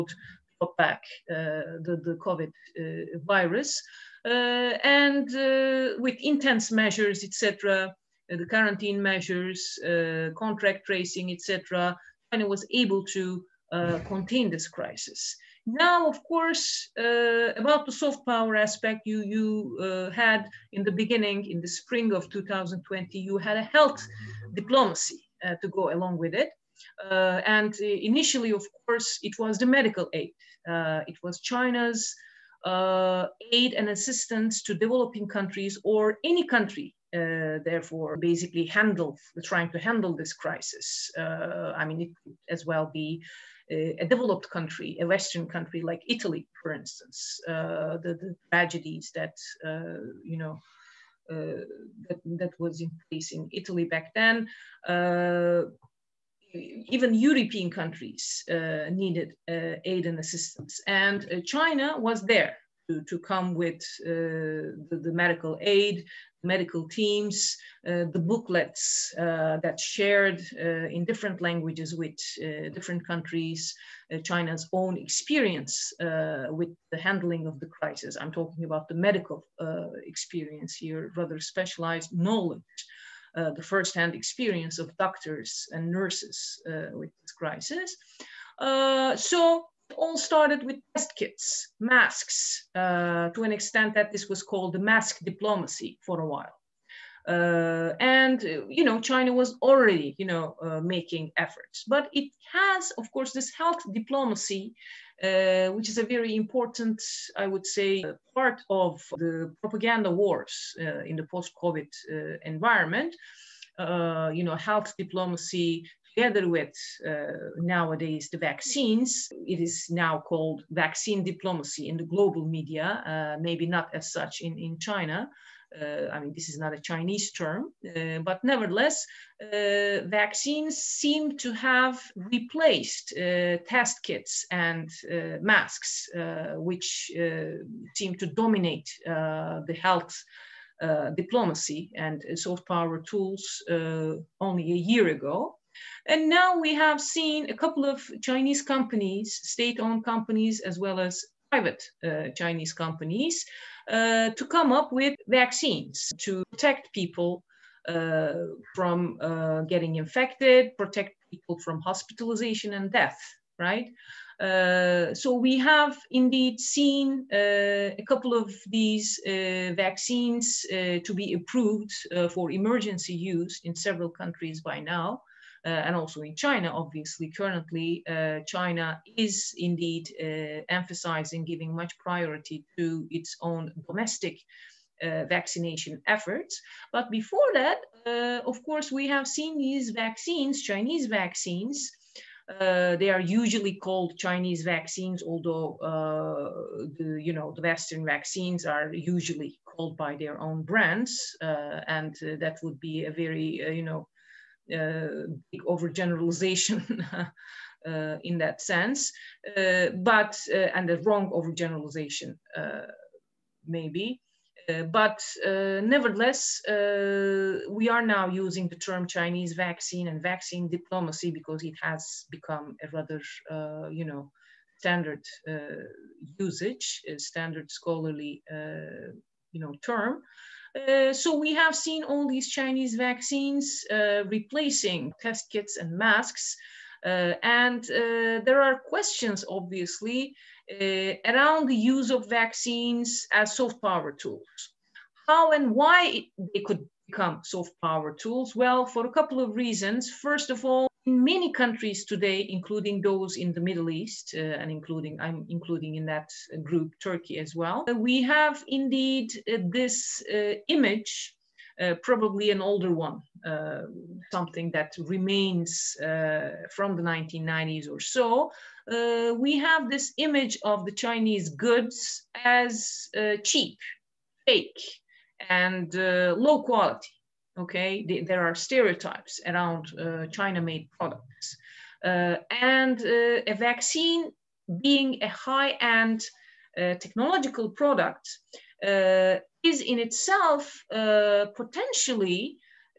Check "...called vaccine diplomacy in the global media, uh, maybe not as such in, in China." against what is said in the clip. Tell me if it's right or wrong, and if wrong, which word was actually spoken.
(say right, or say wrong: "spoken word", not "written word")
right.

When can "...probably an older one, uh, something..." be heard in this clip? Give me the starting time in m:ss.
4:22.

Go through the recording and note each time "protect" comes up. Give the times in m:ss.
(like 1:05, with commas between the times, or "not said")
2:36, 2:40.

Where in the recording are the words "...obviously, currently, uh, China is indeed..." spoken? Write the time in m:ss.
2:56.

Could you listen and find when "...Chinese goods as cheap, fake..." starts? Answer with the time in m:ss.
4:30.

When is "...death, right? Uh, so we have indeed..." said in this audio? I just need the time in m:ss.
2:42.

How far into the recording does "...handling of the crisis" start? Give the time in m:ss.
1:16.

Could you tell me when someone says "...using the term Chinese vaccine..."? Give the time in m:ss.
3:38.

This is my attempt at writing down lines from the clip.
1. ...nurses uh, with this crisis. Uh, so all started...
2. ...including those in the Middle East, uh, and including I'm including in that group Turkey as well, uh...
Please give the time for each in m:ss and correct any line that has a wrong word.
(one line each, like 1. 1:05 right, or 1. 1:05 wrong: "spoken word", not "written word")
1. 1:25 right
2. 4:12 right.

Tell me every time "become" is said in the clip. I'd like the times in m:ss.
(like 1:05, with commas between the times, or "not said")
3:42, 4:07.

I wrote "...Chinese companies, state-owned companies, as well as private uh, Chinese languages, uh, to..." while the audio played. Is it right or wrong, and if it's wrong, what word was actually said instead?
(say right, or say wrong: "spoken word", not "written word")
wrong: "companies", not "languages".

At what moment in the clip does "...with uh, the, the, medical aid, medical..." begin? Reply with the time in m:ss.
1:03.